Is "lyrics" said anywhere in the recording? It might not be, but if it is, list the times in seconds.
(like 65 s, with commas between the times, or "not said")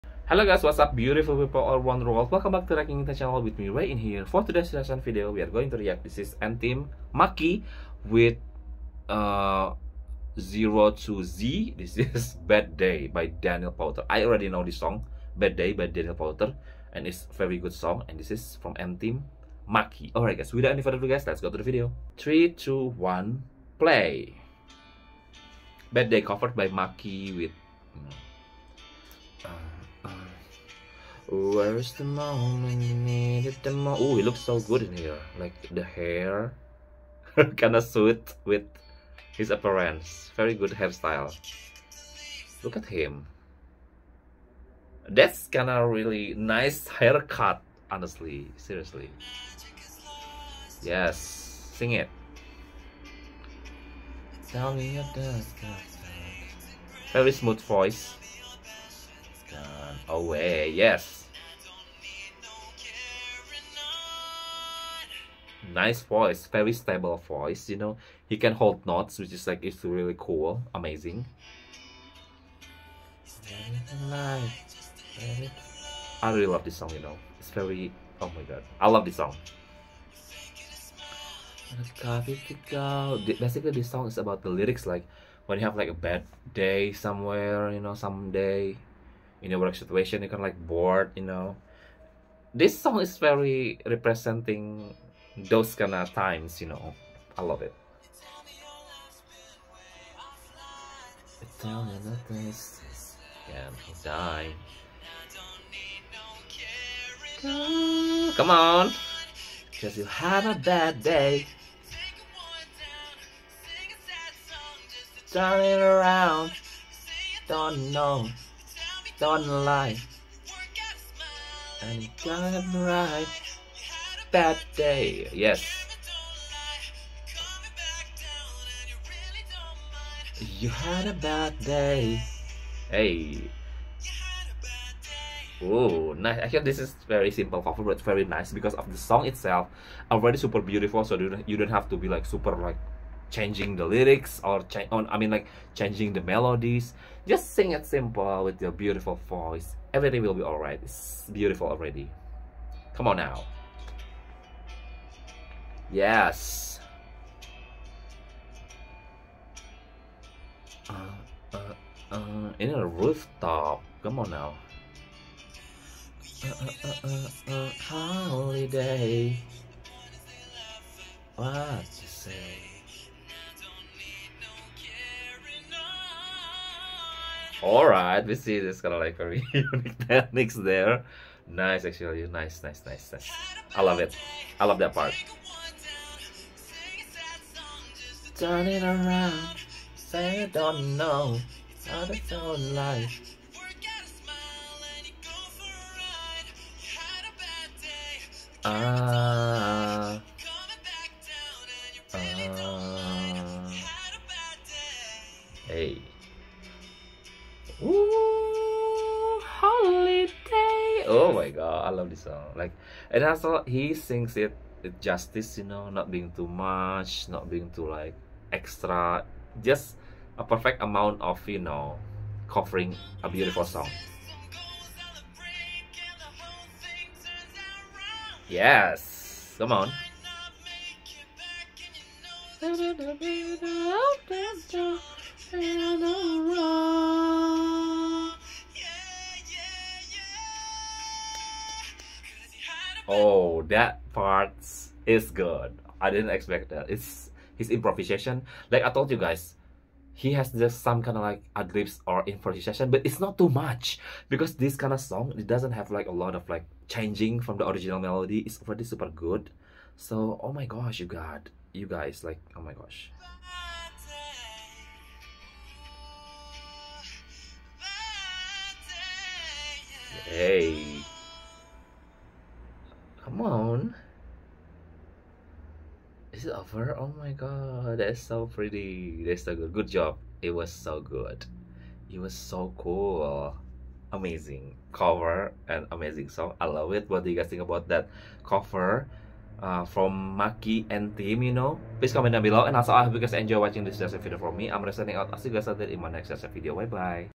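84 s, 143 s.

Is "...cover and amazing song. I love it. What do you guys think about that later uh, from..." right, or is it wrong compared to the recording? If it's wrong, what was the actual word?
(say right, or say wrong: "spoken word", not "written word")
wrong: "cover", not "later".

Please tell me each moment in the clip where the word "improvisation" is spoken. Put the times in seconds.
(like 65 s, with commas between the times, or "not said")
247 s, 252 s.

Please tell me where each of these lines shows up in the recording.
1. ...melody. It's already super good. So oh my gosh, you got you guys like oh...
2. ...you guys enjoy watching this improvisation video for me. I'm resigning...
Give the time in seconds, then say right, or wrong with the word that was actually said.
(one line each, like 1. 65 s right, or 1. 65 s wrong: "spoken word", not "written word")
1. 257 s right
2. 293 s wrong: "lesson", not "improvisation".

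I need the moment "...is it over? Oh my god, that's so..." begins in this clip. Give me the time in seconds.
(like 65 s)
276 s.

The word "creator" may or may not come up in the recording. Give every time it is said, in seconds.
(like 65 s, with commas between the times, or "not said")
not said.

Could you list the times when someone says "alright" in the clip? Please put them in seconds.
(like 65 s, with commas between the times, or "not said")
20 s, 150 s, 177 s.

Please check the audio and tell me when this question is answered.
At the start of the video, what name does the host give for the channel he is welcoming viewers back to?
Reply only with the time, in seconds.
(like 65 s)
2 s.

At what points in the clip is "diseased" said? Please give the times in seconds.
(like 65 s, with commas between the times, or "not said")
not said.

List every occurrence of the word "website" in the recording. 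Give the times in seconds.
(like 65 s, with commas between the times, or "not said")
not said.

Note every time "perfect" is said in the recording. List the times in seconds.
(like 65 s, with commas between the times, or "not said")
220 s.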